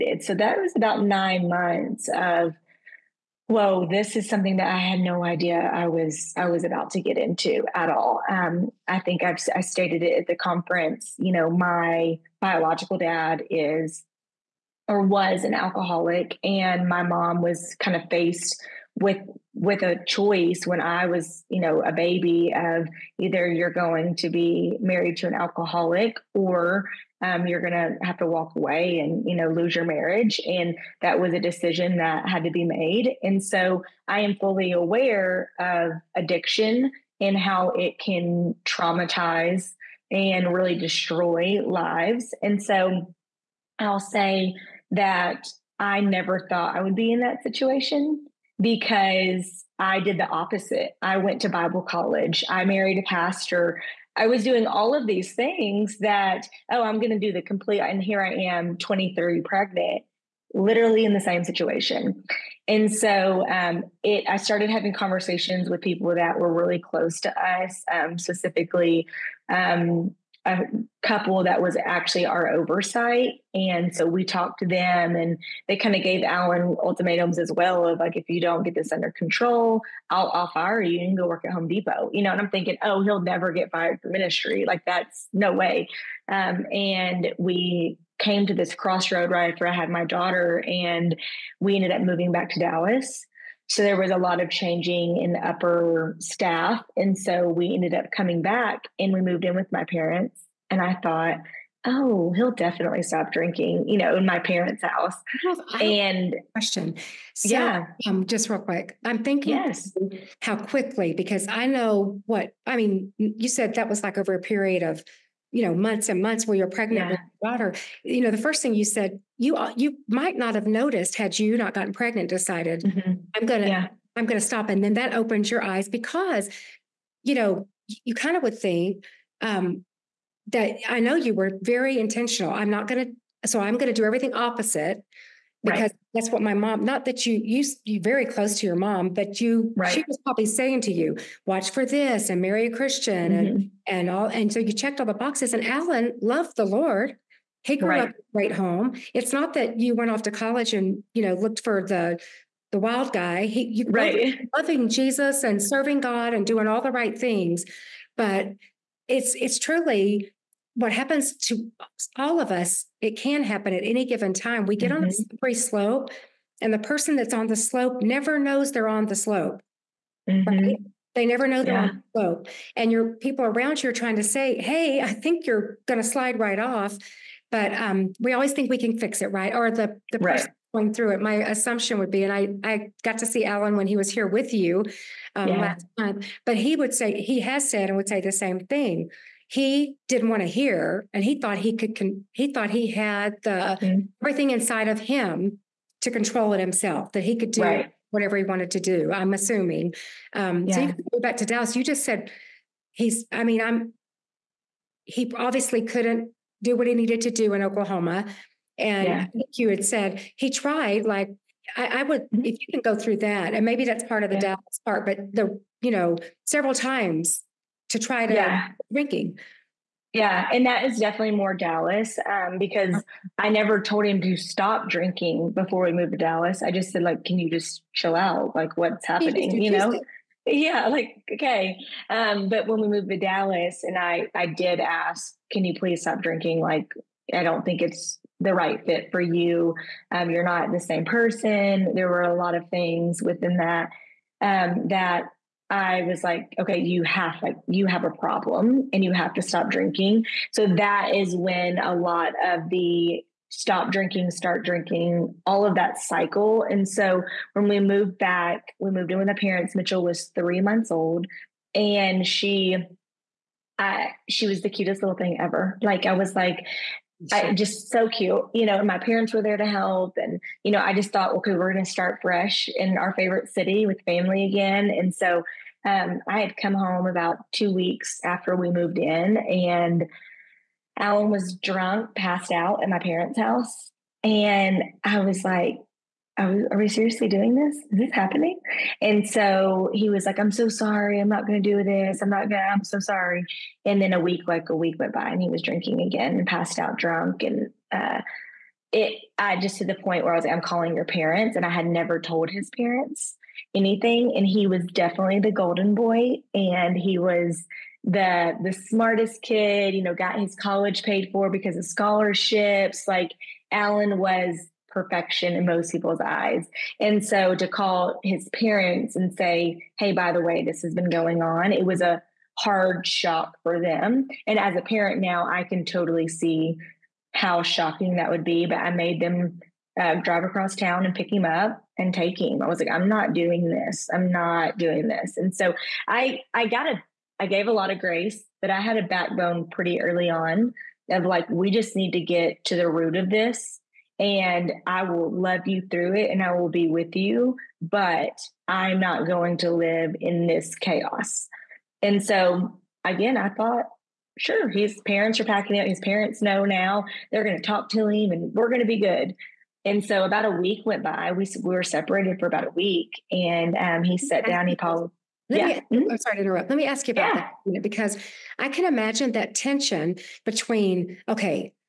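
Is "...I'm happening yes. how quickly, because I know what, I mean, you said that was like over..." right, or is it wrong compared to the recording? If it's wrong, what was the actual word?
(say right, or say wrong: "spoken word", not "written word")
wrong: "thinking", not "happening".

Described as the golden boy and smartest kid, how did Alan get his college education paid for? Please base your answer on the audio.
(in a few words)
Scholarships.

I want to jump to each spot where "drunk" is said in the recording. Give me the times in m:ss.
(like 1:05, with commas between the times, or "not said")
4:41, 4:56.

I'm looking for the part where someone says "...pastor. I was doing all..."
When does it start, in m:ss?
0:53.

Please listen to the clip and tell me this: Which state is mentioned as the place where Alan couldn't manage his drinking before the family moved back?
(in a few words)
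Oklahoma.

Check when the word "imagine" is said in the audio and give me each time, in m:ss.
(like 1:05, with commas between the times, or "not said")
6:08.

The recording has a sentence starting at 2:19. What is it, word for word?
she was probably saying to you watch for this and marry a christian mm-hmm.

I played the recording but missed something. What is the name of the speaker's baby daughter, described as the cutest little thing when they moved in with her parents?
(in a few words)
Mitchell.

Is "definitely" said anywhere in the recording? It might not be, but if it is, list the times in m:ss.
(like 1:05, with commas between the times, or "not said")
1:42, 3:40, 5:04.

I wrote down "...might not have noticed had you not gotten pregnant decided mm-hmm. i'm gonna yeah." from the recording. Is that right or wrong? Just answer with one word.
right.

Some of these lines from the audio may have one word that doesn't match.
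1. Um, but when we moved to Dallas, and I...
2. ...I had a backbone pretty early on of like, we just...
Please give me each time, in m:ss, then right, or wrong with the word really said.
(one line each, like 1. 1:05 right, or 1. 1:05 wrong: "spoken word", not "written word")
1. 3:52 right
2. 5:38 right.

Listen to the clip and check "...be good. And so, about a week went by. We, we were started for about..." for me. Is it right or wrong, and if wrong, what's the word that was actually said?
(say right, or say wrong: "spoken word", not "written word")
wrong: "separated", not "started".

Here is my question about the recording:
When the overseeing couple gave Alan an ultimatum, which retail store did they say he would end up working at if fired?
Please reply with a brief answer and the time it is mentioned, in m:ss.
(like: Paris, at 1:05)
Home Depot, at 1:21.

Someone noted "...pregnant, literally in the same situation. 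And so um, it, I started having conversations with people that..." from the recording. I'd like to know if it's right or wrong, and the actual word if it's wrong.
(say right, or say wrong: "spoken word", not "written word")
right.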